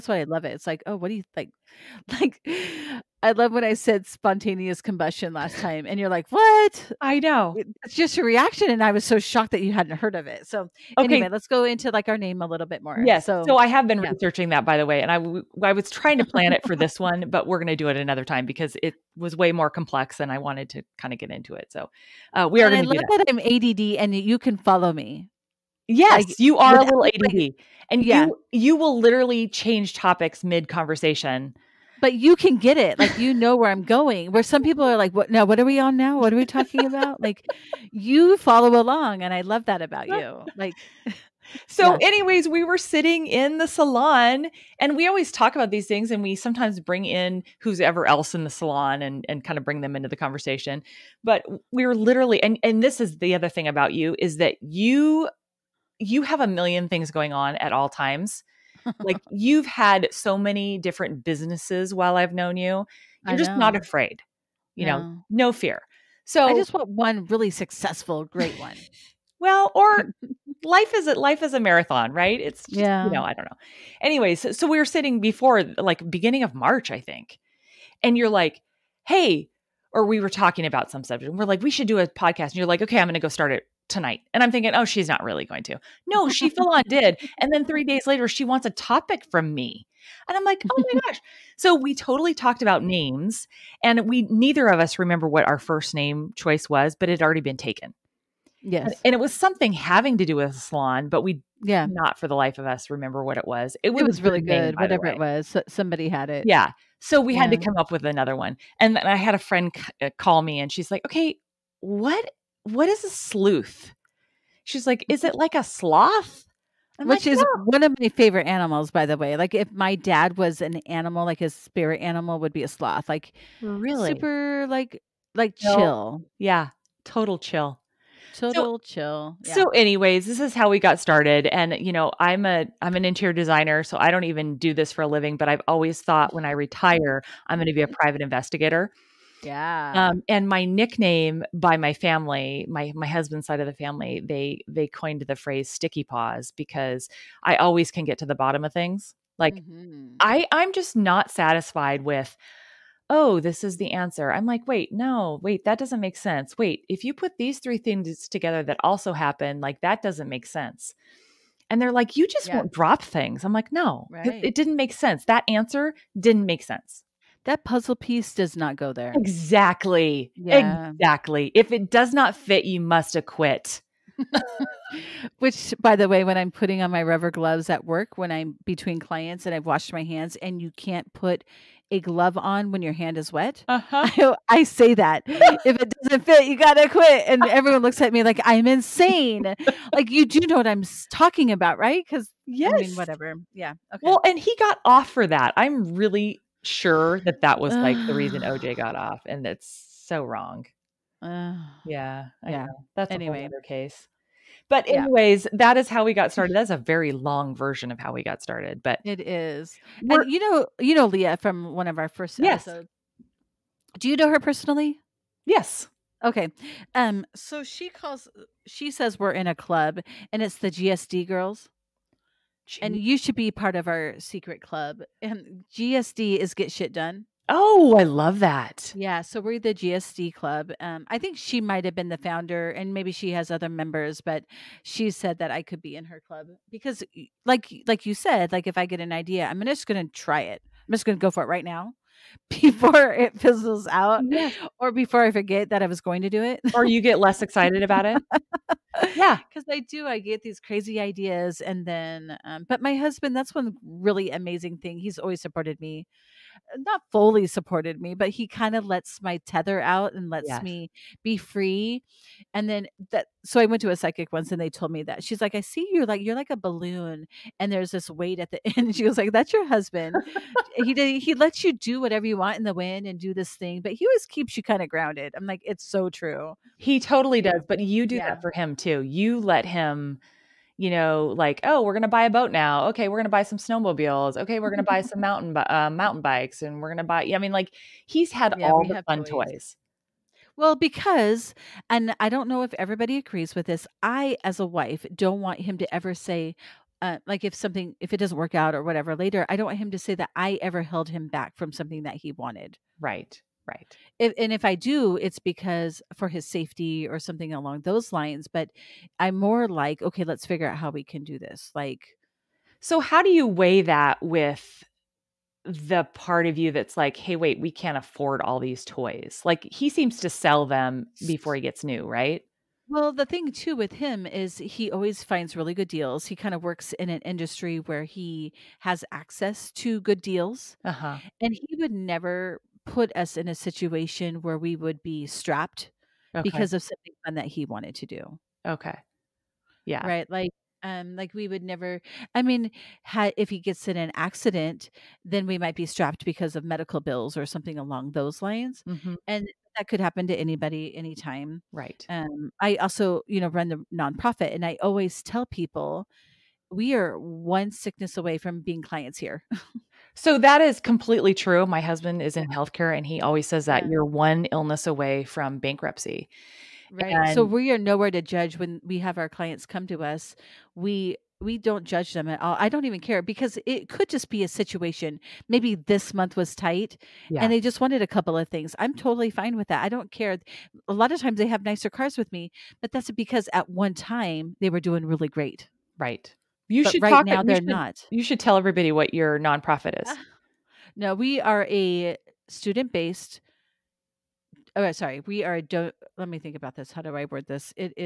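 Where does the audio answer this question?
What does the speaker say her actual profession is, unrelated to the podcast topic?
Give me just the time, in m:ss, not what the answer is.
2:13.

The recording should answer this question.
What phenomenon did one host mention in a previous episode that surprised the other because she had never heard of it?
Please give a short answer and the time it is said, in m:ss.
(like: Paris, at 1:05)
spontaneous combustion, at 0:04.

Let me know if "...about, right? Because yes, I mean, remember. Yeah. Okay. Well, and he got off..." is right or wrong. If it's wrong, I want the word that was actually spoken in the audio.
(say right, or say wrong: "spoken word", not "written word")
wrong: "whatever", not "remember".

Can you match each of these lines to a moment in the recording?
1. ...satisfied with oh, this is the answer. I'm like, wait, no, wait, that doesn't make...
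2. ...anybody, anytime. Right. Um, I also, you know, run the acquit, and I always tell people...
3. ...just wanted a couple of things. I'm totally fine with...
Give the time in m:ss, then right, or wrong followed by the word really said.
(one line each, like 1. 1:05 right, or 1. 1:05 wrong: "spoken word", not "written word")
1. 2:31 right
2. 5:50 wrong: "nonprofit", not "acquit"
3. 6:17 right.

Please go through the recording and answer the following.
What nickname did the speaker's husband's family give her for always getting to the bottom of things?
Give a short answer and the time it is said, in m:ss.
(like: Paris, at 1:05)
sticky paws, at 2:25.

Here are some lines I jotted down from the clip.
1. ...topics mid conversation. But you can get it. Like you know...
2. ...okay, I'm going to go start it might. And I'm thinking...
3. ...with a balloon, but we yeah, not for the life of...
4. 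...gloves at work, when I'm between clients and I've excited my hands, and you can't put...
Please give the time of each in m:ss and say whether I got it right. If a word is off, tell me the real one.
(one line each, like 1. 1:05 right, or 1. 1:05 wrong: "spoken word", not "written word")
1. 0:29 right
2. 1:22 wrong: "tonight", not "might"
3. 1:40 wrong: "salon", not "balloon"
4. 2:57 wrong: "washed", not "excited".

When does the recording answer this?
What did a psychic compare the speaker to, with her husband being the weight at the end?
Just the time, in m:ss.
4:26.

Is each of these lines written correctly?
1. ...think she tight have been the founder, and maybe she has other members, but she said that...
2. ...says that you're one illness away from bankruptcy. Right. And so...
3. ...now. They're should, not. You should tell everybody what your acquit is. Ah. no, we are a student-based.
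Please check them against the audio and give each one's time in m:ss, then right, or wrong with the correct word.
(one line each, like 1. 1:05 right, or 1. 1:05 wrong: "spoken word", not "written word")
1. 3:51 wrong: "might", not "tight"
2. 6:03 right
3. 6:27 wrong: "nonprofit", not "acquit".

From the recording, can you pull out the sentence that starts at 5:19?
Like, he seems to sell them before he gets new, right?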